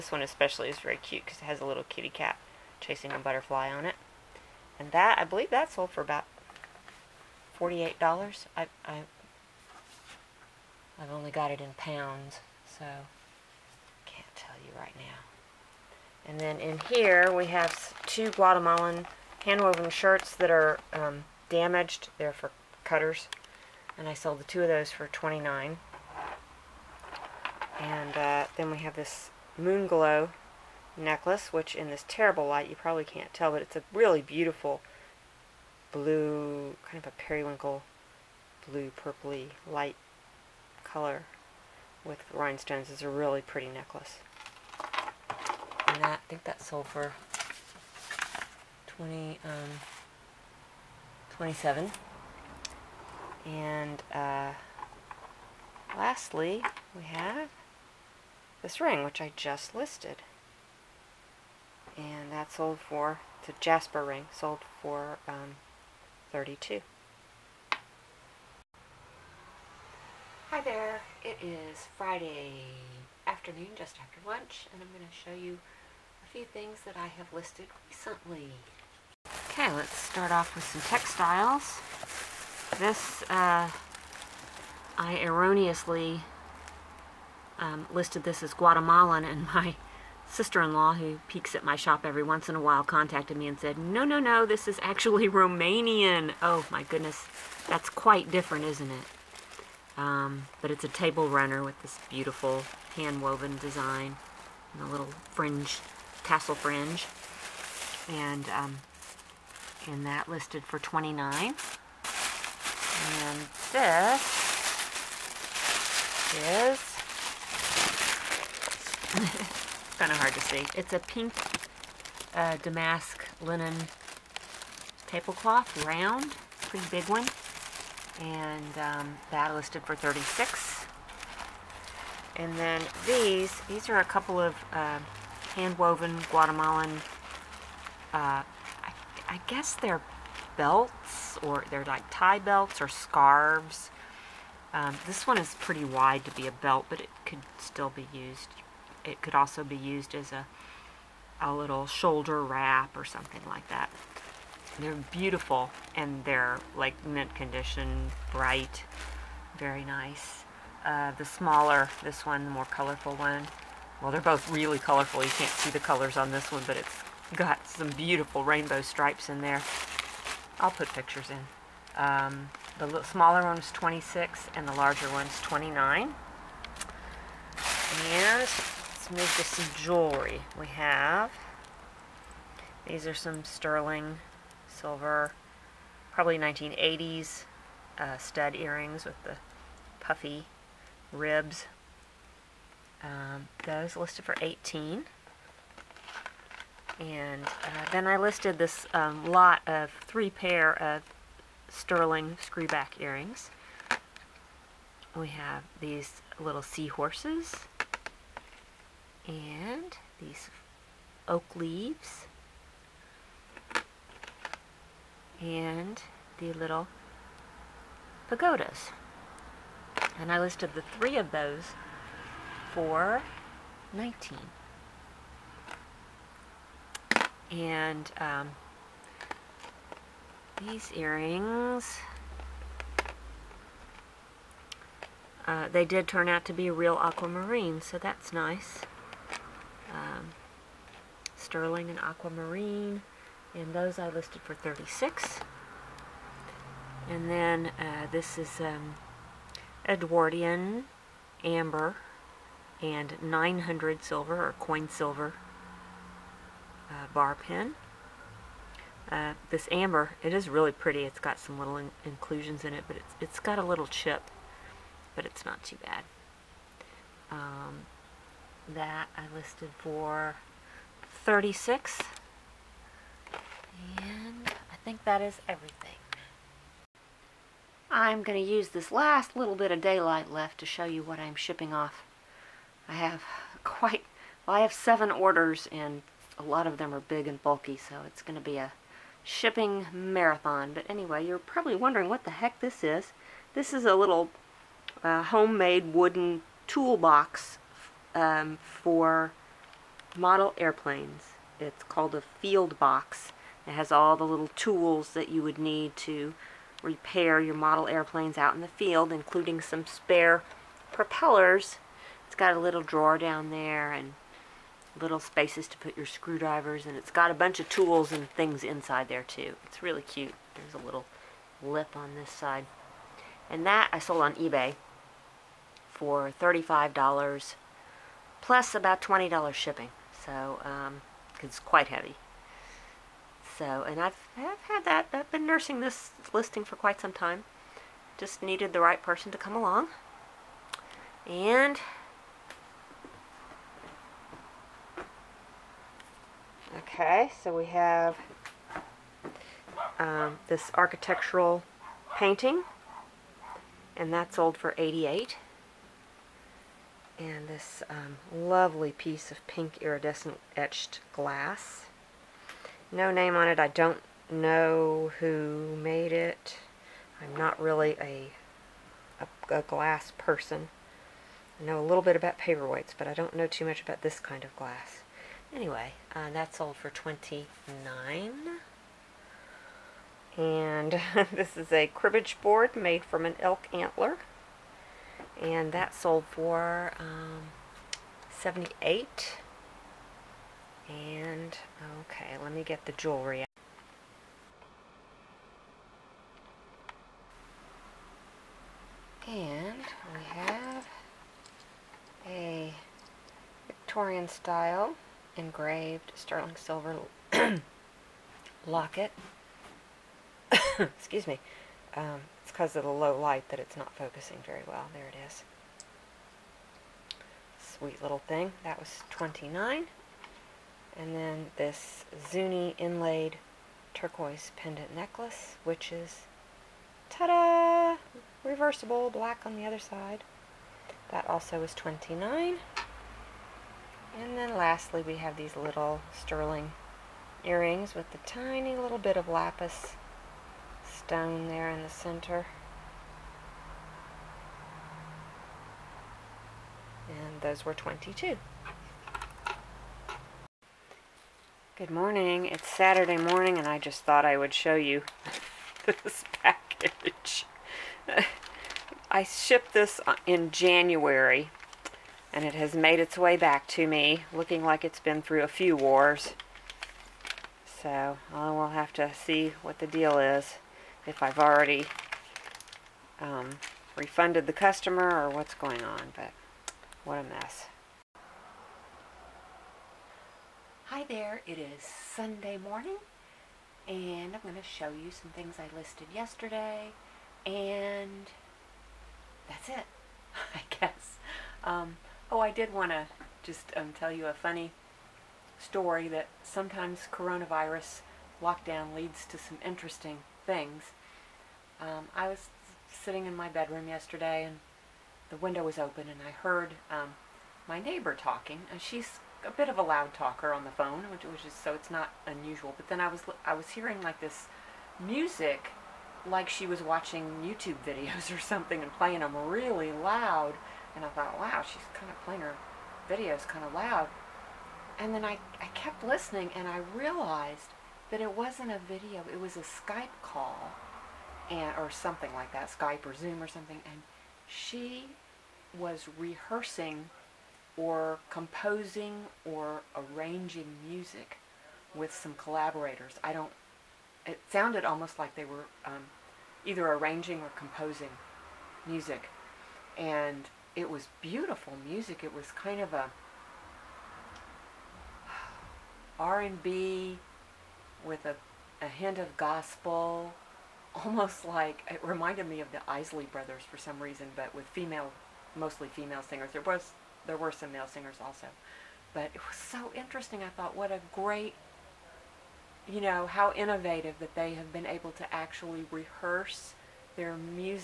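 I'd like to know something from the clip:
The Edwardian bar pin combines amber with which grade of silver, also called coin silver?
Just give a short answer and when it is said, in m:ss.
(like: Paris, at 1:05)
900 silver, at 4:13.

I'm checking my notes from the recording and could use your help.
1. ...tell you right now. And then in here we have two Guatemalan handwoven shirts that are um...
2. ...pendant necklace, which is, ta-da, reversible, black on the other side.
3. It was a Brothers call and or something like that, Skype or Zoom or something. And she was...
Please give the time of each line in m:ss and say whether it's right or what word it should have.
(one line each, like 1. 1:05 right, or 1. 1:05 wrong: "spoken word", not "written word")
1. 0:14 right
2. 7:04 right
3. 8:49 wrong: "Skype", not "Brothers".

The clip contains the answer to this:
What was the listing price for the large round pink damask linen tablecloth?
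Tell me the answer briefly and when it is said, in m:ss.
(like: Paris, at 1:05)
36, at 2:09.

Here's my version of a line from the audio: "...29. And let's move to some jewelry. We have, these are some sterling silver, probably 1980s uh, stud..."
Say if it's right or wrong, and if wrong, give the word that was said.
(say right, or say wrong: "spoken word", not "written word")
right.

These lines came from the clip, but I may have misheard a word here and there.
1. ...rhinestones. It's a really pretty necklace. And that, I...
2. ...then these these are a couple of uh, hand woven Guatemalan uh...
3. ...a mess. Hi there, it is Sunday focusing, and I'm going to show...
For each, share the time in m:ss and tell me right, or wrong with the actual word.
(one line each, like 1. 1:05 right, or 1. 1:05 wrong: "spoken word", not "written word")
1. 0:42 right
2. 2:12 right
3. 7:57 wrong: "morning", not "focusing".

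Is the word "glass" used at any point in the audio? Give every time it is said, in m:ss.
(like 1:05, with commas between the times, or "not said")
6:01, 6:09, 6:14.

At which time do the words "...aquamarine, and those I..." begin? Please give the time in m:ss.
4:01.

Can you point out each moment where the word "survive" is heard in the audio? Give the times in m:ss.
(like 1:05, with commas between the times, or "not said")
not said.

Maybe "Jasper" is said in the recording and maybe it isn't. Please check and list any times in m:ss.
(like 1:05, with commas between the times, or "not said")
1:03.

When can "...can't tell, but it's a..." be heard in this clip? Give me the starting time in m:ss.
0:33.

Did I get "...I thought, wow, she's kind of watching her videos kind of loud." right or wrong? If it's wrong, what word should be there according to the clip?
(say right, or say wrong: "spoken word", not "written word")
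wrong: "playing", not "watching".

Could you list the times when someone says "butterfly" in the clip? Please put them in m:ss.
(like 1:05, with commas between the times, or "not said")
0:03.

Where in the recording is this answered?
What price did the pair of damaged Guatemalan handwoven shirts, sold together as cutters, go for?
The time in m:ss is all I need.
0:24.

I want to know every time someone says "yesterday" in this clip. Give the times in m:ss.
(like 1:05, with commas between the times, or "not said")
8:06, 8:23.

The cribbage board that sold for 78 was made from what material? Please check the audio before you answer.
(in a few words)
elk antler.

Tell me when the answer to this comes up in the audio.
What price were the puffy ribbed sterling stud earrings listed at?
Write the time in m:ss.
3:13.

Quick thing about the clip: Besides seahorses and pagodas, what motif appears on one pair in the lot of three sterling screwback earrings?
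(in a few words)
oak leaves.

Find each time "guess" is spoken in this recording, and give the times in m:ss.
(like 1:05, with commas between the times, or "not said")
2:19, 8:10.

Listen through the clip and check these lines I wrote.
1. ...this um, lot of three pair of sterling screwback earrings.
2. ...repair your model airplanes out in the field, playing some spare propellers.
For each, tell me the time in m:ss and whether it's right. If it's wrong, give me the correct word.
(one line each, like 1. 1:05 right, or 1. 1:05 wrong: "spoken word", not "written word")
1. 3:18 right
2. 5:06 wrong: "including", not "playing".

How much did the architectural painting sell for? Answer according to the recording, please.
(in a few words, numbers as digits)
88.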